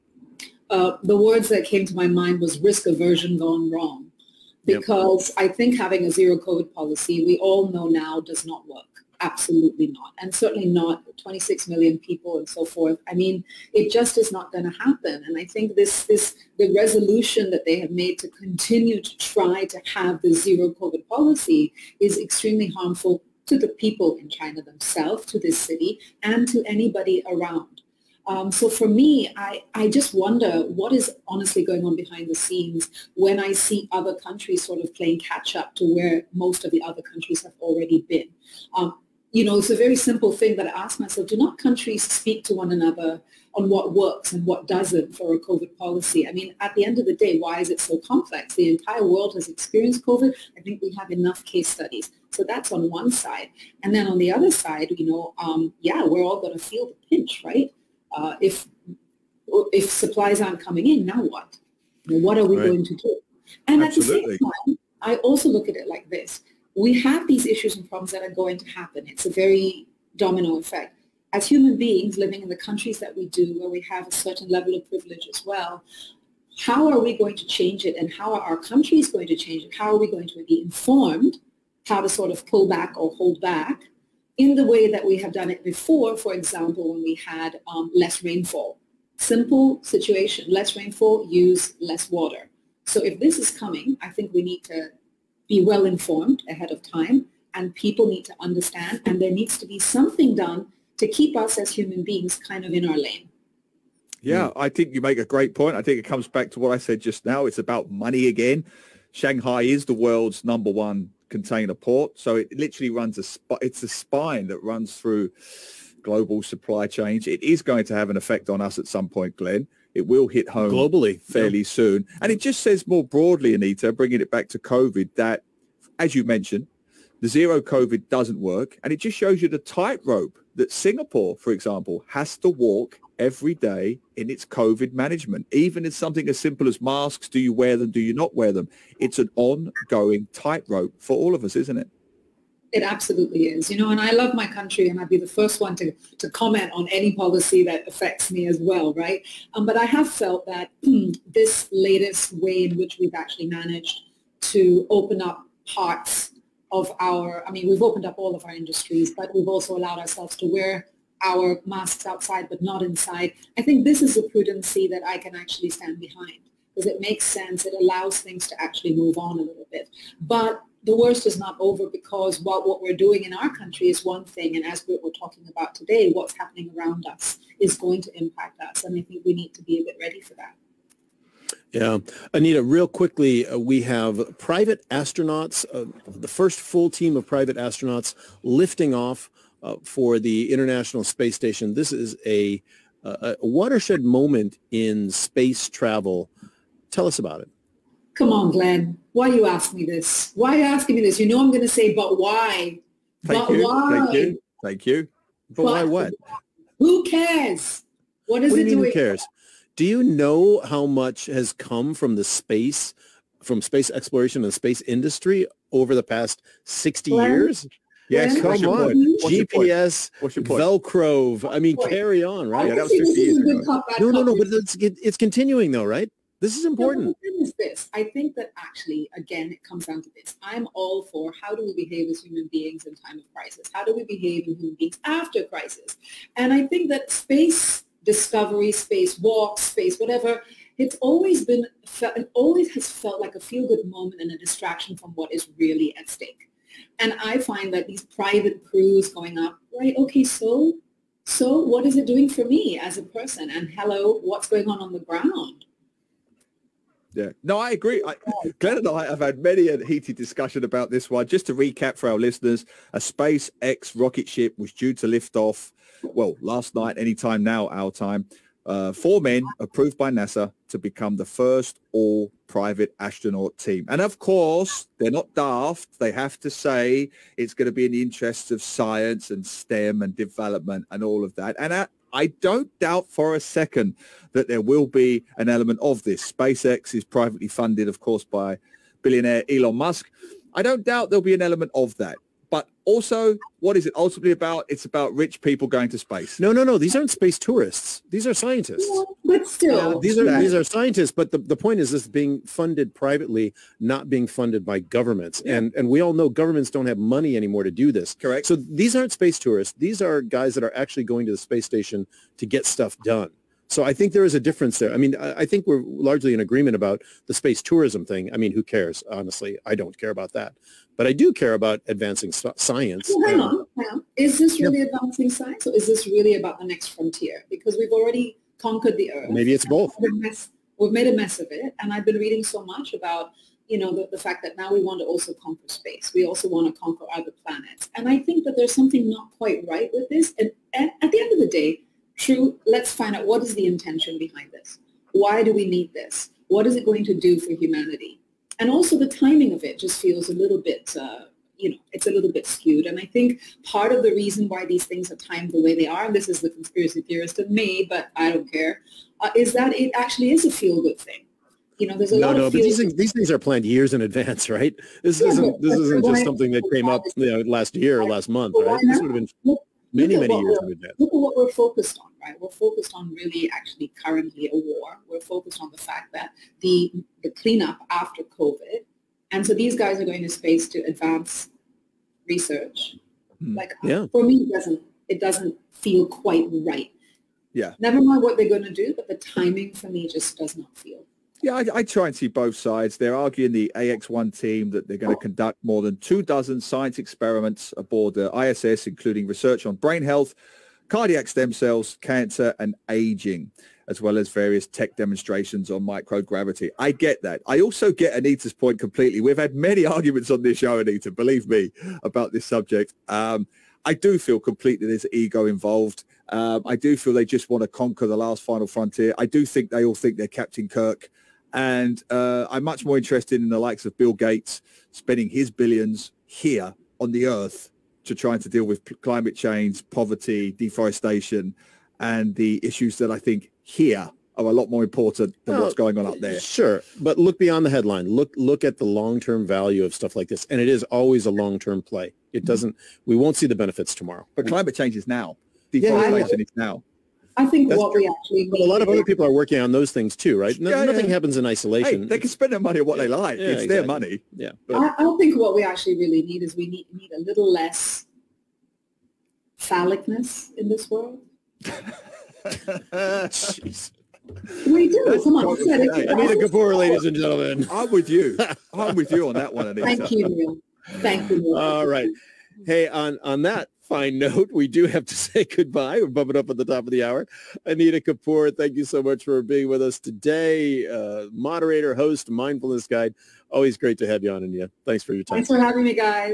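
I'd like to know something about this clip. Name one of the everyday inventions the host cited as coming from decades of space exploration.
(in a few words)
Velcro.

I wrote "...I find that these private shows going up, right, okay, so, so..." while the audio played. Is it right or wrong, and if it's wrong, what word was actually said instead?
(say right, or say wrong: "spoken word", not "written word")
wrong: "crews", not "shows".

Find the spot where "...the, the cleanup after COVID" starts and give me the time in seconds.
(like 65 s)
376 s.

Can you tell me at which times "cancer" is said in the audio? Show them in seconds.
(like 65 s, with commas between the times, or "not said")
401 s.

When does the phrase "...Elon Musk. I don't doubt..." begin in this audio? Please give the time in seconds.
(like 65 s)
289 s.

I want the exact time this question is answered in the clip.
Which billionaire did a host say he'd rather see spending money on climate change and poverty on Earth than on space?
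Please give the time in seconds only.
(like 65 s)
423 s.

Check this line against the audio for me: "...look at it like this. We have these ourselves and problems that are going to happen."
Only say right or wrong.
wrong.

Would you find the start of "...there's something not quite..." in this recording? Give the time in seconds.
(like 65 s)
338 s.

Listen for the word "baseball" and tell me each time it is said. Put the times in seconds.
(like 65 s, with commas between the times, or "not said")
not said.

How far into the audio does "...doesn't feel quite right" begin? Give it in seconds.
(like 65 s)
385 s.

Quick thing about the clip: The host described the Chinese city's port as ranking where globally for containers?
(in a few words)
number one.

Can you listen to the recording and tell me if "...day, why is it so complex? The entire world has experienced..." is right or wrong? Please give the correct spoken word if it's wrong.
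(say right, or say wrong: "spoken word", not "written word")
right.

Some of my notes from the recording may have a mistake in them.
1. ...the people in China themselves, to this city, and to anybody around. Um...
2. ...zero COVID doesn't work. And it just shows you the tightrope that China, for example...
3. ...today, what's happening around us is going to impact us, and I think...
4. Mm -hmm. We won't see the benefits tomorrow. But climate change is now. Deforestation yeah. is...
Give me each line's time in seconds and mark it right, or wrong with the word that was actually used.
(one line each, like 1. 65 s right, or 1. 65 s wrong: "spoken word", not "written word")
1. 23 s right
2. 127 s wrong: "Singapore", not "China"
3. 175 s right
4. 442 s right.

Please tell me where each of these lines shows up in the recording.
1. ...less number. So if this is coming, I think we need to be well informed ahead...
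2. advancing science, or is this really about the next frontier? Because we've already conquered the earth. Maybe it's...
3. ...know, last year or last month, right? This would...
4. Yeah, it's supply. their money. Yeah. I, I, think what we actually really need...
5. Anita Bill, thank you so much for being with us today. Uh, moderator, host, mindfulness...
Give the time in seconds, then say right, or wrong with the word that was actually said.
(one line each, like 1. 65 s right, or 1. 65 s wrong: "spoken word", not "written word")
1. 91 s wrong: "water", not "number"
2. 324 s right
3. 367 s right
4. 453 s wrong: "exactly", not "supply"
5. 477 s wrong: "Kapoor", not "Bill".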